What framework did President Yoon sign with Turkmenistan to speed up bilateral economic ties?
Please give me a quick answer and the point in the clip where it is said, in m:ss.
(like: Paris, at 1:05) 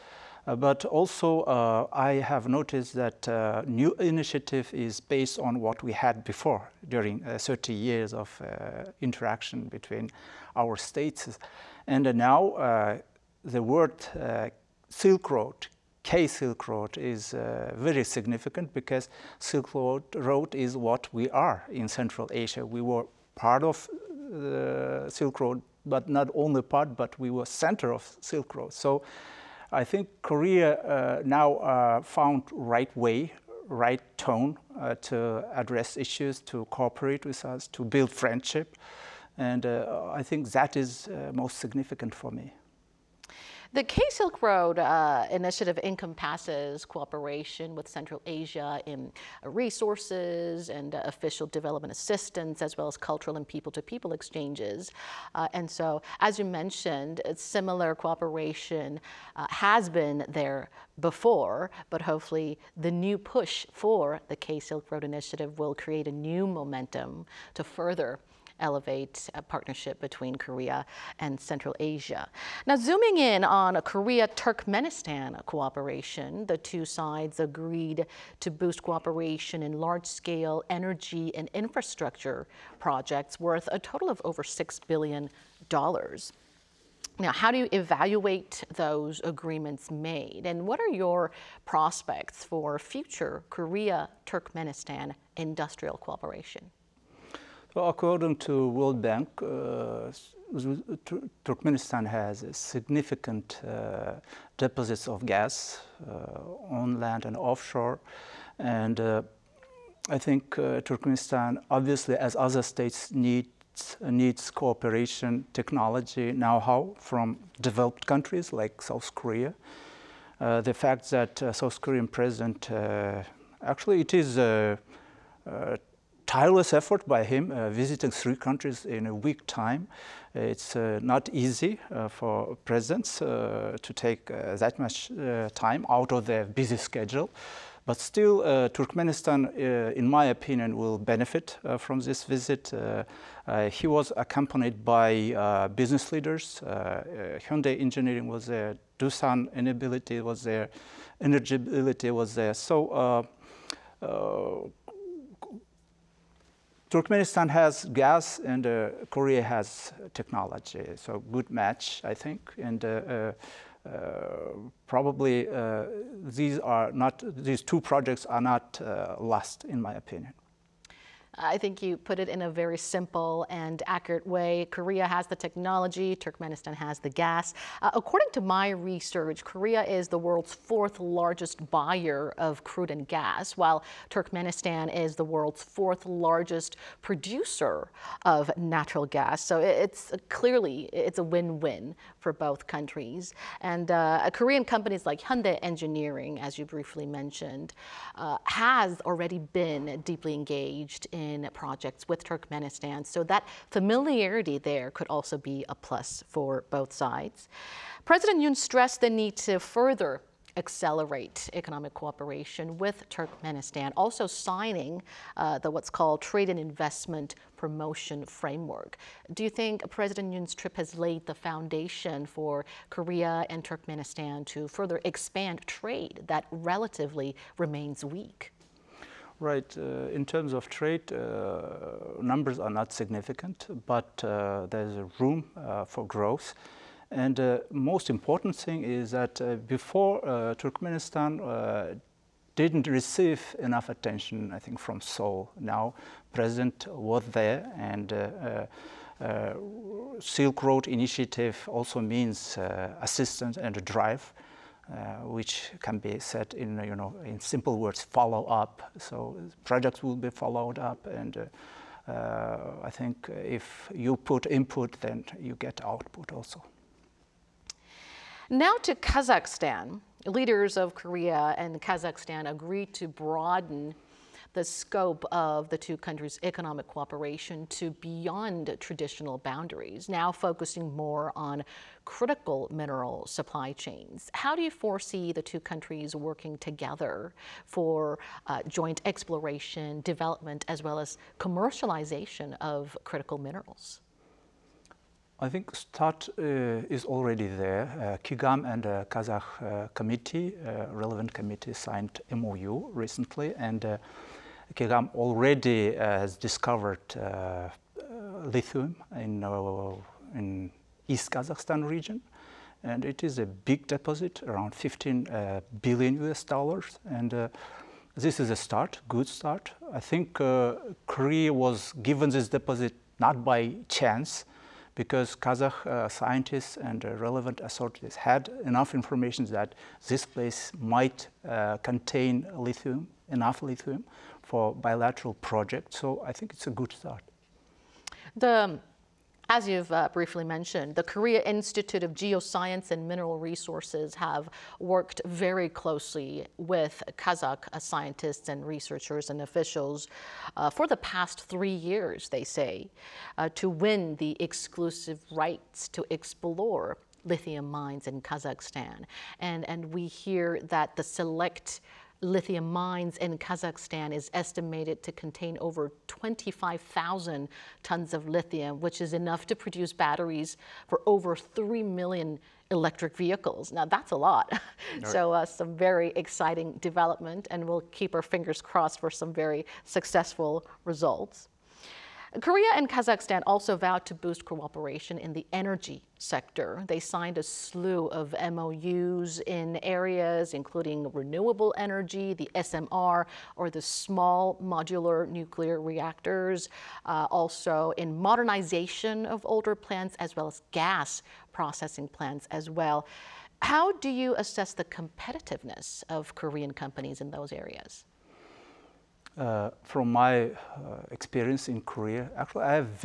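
Trade and Investment Promotion Framework, at 3:36.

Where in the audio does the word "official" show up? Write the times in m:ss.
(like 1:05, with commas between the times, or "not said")
0:51, 5:49.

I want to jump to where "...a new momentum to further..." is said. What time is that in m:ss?
1:06.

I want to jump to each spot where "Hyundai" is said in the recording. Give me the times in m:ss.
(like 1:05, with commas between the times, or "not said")
2:27, 3:15.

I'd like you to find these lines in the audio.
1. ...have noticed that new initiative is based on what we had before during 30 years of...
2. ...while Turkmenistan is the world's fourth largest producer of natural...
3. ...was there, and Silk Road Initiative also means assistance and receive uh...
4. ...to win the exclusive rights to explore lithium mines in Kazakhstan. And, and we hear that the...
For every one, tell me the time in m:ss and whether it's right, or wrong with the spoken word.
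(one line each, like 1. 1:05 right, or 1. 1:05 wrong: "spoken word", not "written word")
1. 0:02 right
2. 3:03 right
3. 4:06 wrong: "drive", not "receive"
4. 5:53 right.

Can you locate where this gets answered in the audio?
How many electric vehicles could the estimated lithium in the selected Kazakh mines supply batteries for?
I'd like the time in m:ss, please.
6:11.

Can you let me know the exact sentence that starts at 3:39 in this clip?
Do you think President Yoon's trip has laid the foundation for Korea and Turkmenistan to further expand trade that relatively remains weak?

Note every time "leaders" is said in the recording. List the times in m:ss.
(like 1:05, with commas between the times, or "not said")
2:26, 4:30.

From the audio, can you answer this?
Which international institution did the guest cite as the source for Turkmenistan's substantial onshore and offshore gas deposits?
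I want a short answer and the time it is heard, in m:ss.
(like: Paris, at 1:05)
World Bank, at 1:38.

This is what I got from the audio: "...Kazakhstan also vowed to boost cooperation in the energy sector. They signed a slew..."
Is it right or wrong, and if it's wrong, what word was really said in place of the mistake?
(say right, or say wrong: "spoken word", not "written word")
right.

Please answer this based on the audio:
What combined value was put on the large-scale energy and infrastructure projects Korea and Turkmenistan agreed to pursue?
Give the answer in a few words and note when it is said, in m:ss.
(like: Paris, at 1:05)
over $6 billion, at 1:24.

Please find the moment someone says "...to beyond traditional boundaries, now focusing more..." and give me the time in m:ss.
4:37.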